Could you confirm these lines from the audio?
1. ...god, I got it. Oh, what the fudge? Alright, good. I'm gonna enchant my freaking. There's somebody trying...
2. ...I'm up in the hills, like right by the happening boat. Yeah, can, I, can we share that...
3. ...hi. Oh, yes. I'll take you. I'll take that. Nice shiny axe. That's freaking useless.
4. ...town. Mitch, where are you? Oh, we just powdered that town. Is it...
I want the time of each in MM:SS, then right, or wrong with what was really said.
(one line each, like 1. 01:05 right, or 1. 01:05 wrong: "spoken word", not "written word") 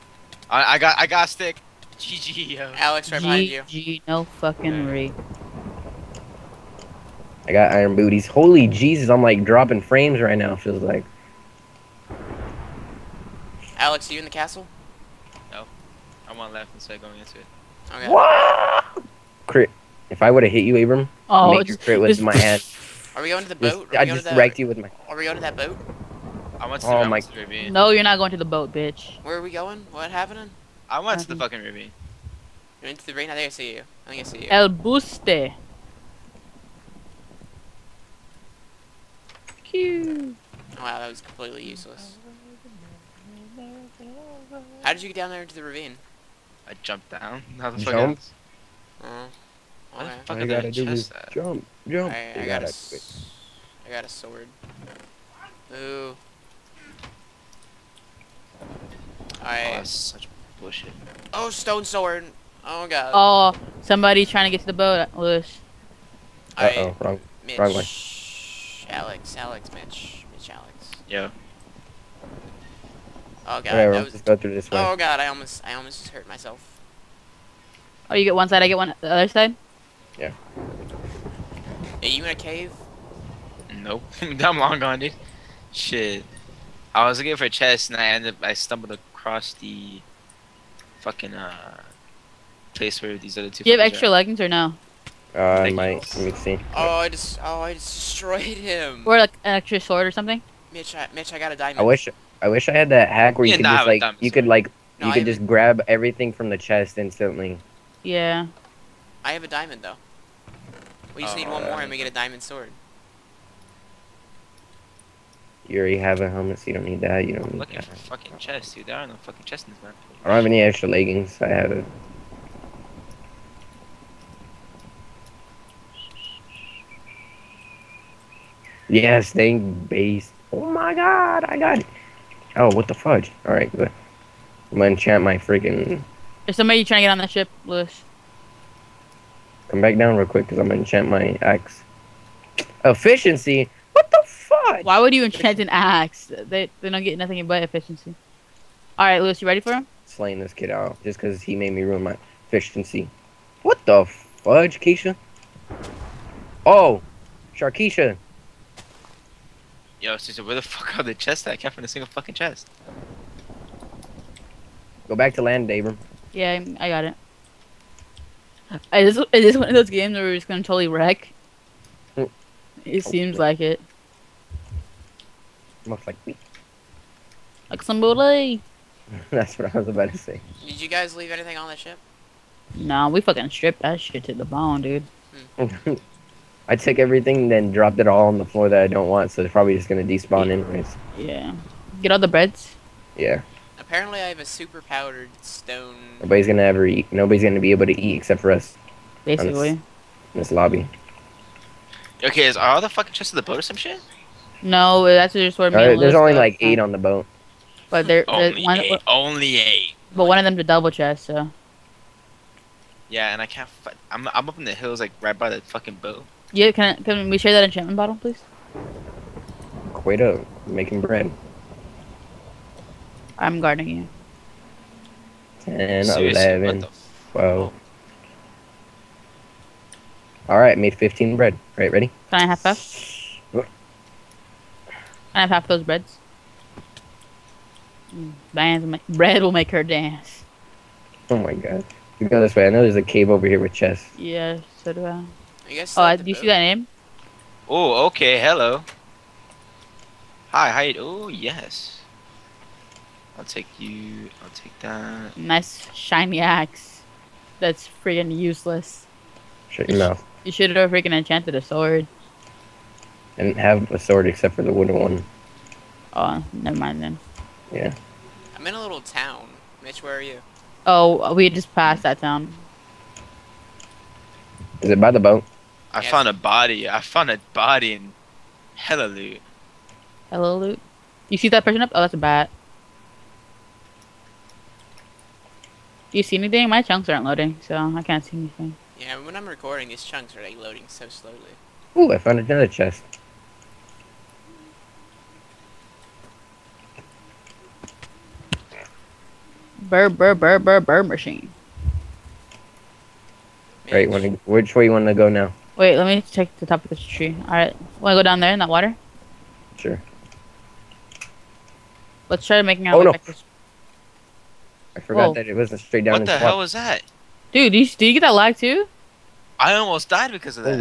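1. 02:10 right
2. 03:34 wrong: "fucking", not "happening"
3. 04:10 right
4. 04:28 wrong: "passed", not "powdered".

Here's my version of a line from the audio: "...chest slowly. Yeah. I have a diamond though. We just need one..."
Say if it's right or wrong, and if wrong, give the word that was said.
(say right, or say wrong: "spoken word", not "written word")
wrong: "instantly", not "slowly".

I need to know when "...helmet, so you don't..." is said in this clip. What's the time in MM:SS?
01:56.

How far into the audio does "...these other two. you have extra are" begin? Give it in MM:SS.
01:33.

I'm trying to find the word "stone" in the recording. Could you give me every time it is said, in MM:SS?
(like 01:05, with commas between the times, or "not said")
01:01, 03:15.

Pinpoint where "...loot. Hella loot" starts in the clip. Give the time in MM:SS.
04:39.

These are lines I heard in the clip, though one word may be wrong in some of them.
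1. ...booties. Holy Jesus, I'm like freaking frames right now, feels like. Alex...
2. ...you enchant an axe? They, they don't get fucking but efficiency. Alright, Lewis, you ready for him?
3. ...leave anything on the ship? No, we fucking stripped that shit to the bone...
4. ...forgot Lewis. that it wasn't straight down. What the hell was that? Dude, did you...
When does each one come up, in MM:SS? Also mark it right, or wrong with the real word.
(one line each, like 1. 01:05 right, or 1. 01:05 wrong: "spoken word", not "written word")
1. 00:07 wrong: "dropping", not "freaking"
2. 02:25 wrong: "nothing", not "fucking"
3. 03:01 right
4. 05:14 wrong: "Whoa", not "Lewis".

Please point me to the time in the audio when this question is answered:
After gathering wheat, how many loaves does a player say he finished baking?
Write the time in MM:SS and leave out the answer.
03:50.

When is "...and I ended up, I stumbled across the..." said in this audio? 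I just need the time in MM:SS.
01:27.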